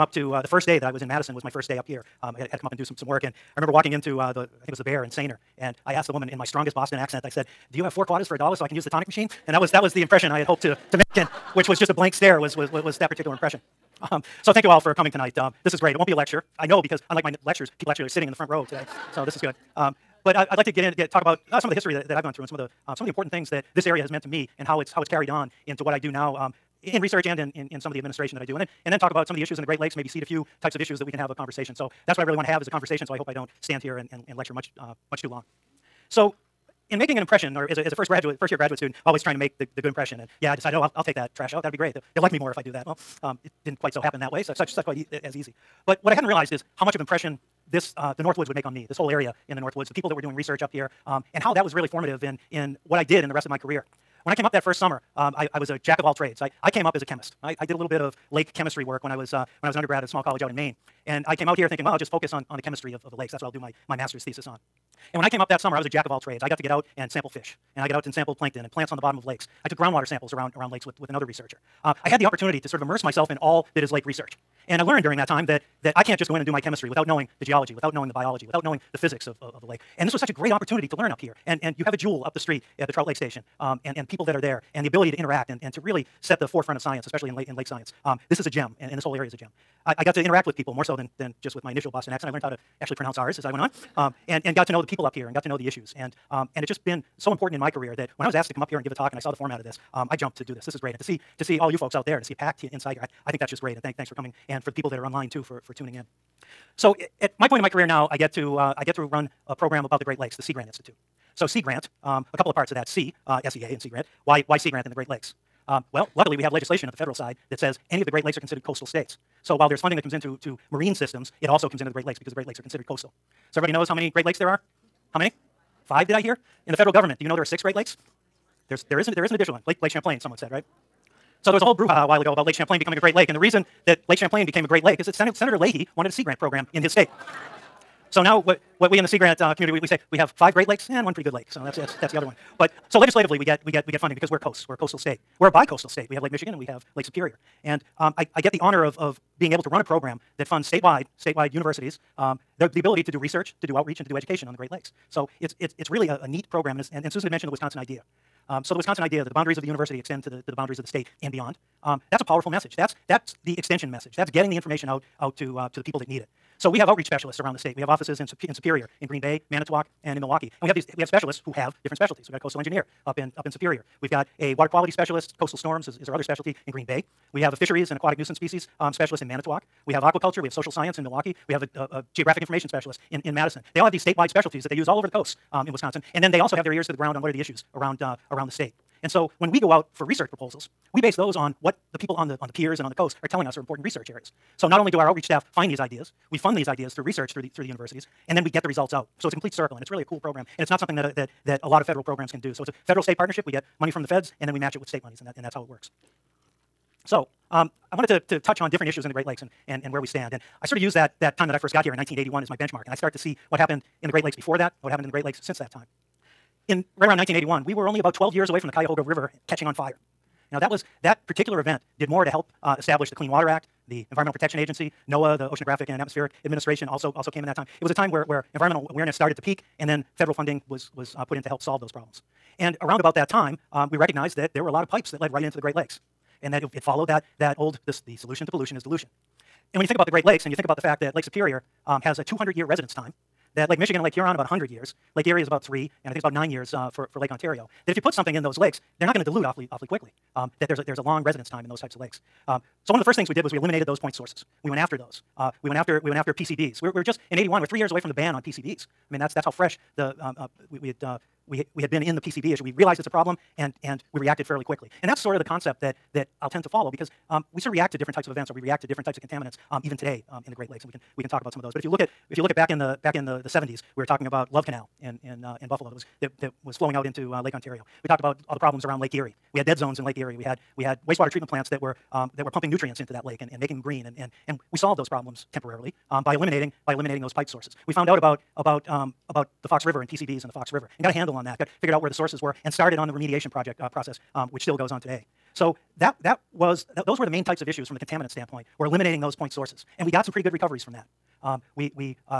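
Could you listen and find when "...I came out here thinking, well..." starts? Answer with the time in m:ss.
1:01.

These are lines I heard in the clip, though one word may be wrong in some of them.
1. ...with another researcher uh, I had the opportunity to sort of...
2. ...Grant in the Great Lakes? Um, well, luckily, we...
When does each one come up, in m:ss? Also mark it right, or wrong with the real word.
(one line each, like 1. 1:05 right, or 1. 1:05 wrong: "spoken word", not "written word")
1. 1:10 right
2. 1:54 right.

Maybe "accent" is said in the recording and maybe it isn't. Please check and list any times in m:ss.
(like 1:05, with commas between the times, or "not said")
0:06, 1:32.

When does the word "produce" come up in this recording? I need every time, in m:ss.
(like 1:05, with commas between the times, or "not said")
not said.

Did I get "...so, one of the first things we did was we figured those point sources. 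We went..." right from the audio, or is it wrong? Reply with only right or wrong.
wrong.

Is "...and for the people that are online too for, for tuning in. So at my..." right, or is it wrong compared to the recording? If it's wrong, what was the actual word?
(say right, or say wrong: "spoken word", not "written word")
right.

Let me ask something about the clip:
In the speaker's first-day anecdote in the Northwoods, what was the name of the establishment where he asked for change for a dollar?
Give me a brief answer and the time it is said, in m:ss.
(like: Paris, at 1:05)
the Bear, at 0:04.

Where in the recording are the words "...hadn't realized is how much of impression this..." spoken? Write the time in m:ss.
0:46.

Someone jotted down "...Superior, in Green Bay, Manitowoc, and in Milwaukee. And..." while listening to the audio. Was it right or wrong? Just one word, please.
right.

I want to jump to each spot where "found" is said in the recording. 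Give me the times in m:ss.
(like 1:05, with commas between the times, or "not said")
4:47.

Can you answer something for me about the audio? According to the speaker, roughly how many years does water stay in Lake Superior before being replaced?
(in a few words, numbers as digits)
200 years.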